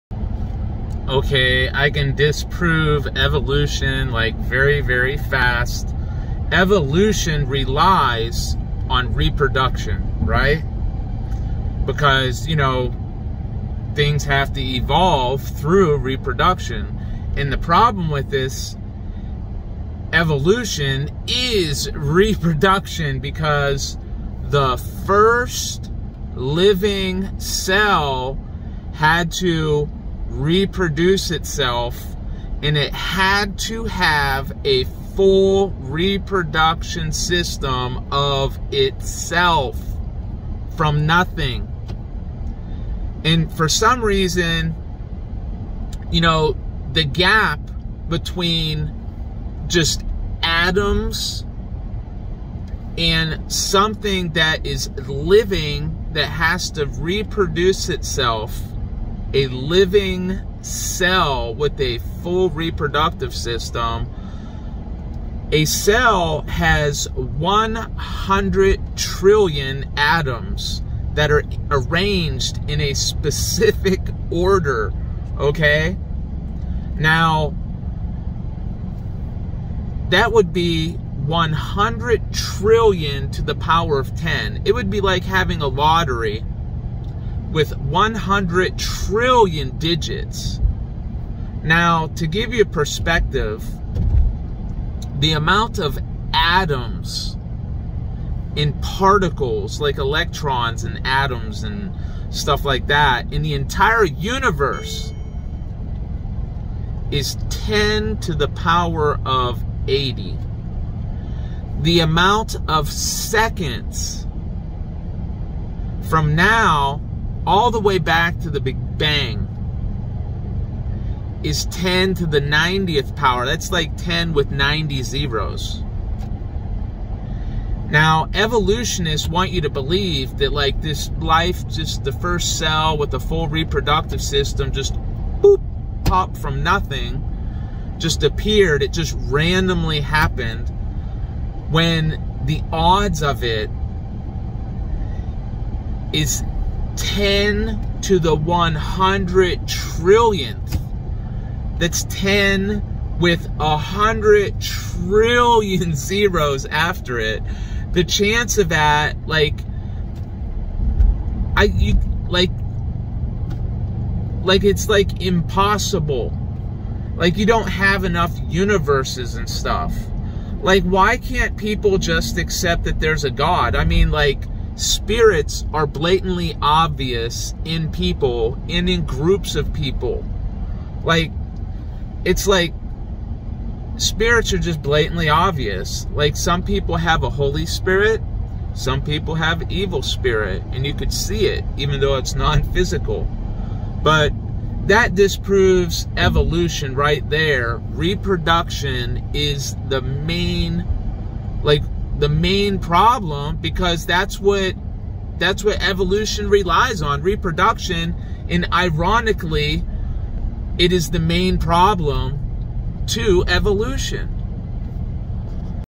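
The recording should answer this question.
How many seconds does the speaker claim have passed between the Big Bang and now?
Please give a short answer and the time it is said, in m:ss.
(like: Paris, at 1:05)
10 to the 90th power, at 2:01.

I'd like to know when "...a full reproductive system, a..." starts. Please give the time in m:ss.
1:01.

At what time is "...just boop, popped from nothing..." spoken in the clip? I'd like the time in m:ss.
2:14.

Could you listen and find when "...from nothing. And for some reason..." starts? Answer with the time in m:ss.
0:40.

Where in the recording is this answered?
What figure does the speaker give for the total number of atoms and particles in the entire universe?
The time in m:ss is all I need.
1:47.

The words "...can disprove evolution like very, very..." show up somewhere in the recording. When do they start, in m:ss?
0:01.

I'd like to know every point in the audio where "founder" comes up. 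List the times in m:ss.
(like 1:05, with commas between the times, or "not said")
not said.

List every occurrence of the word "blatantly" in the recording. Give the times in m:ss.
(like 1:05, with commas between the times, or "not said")
2:55, 3:04.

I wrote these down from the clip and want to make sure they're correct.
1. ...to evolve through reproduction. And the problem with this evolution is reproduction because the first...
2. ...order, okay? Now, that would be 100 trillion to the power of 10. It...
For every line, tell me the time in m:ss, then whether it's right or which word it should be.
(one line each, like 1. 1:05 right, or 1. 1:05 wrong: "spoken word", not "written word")
1. 0:14 right
2. 1:14 right.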